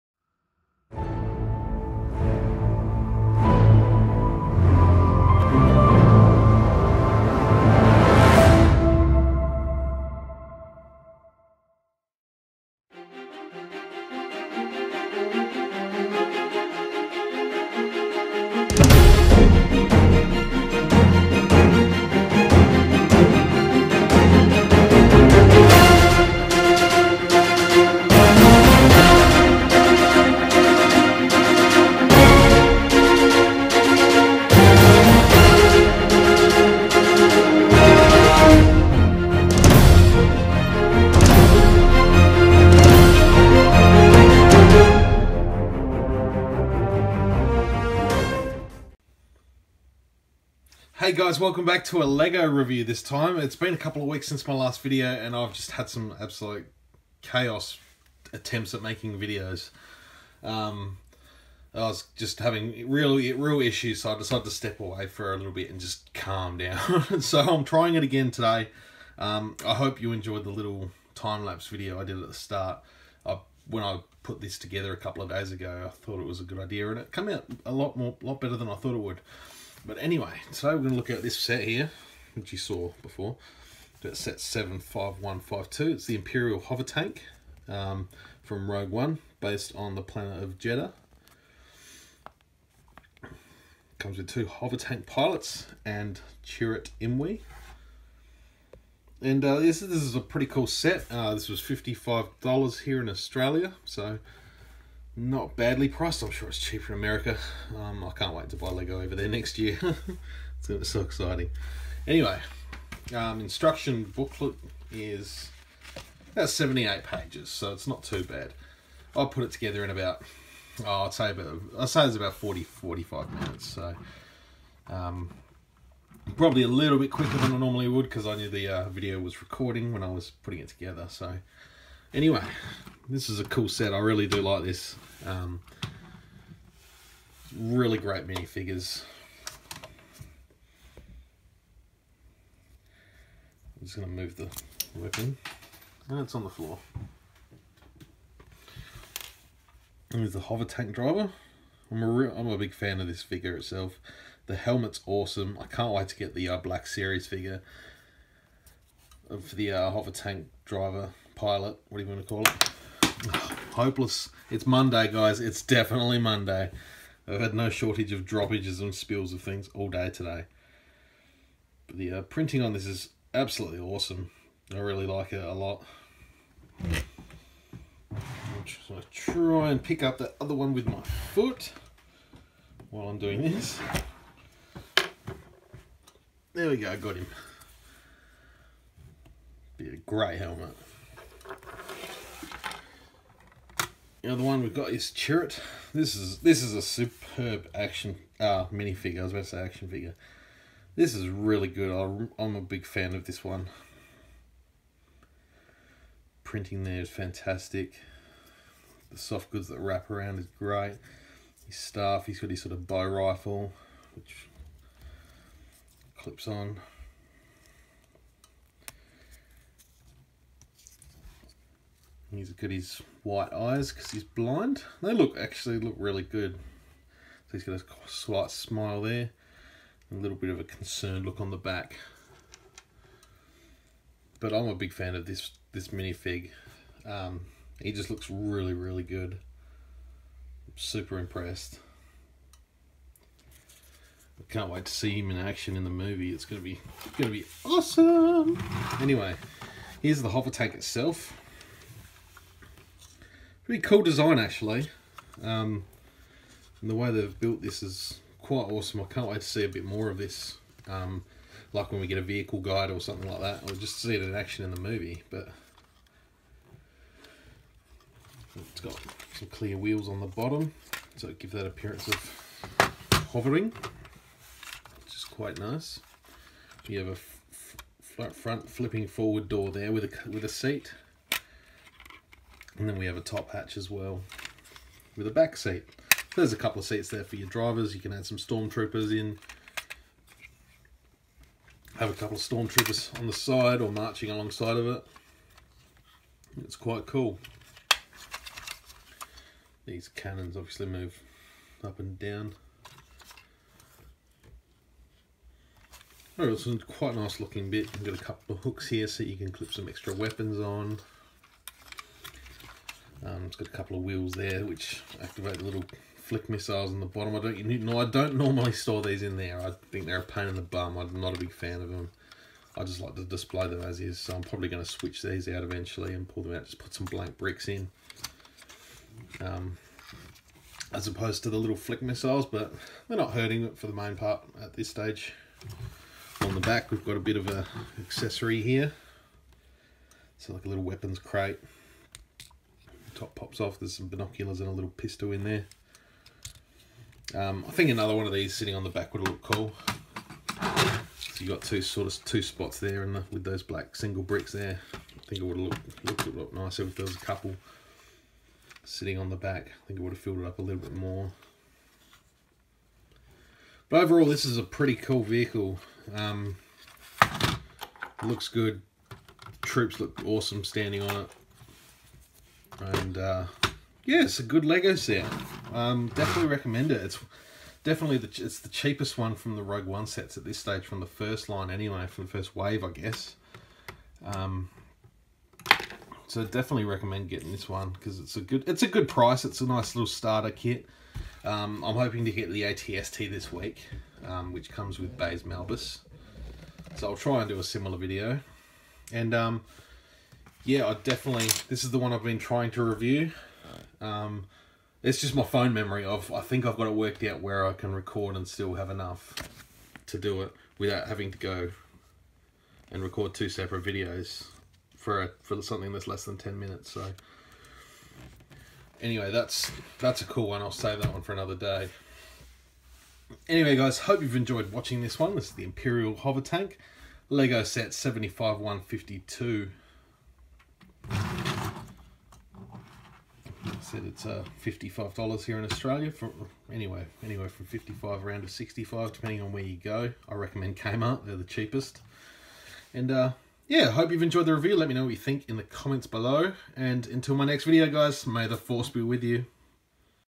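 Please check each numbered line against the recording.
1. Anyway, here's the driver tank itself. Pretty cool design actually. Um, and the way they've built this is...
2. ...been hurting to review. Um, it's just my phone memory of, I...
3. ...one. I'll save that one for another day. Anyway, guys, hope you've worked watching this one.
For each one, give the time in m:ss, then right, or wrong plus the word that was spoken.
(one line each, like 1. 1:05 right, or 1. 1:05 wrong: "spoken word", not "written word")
1. 4:08 wrong: "hover", not "driver"
2. 6:42 wrong: "trying", not "hurting"
3. 7:00 wrong: "enjoyed", not "worked".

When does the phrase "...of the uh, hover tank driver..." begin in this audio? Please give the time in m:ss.
2:39.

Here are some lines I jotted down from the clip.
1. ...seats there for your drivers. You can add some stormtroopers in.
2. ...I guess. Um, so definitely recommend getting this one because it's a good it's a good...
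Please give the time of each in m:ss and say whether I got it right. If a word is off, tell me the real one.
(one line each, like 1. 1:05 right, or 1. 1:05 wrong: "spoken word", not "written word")
1. 4:46 right
2. 6:22 right.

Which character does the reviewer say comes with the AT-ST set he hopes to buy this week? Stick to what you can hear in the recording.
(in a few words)
Baze Malbus.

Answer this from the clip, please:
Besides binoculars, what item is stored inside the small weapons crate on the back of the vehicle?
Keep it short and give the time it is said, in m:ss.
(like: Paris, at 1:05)
pistol, at 5:44.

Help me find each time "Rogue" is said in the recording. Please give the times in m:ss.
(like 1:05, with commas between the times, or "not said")
1:28, 6:19.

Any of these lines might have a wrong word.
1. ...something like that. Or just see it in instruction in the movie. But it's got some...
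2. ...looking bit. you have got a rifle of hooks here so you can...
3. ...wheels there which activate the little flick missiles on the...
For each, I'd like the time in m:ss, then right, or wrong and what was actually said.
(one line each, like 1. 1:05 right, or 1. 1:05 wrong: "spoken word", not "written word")
1. 4:22 wrong: "action", not "instruction"
2. 5:07 wrong: "couple", not "rifle"
3. 5:14 right.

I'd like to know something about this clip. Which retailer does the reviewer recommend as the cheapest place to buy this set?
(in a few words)
Kmart.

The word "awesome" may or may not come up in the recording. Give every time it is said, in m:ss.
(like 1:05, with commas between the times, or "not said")
2:35, 2:53, 4:07, 4:18, 6:10.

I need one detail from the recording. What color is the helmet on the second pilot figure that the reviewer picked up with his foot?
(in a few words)
grey.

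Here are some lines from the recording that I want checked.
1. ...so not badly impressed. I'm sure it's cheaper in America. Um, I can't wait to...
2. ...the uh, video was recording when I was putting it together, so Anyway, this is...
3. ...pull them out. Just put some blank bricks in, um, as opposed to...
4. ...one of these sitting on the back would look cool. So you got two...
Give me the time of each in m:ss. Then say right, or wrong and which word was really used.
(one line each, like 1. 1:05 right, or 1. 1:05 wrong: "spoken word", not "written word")
1. 1:43 wrong: "priced", not "impressed"
2. 2:08 right
3. 5:26 right
4. 5:48 right.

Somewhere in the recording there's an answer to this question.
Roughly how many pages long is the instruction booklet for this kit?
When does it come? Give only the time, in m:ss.
1:56.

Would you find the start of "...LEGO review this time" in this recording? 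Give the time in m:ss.
0:52.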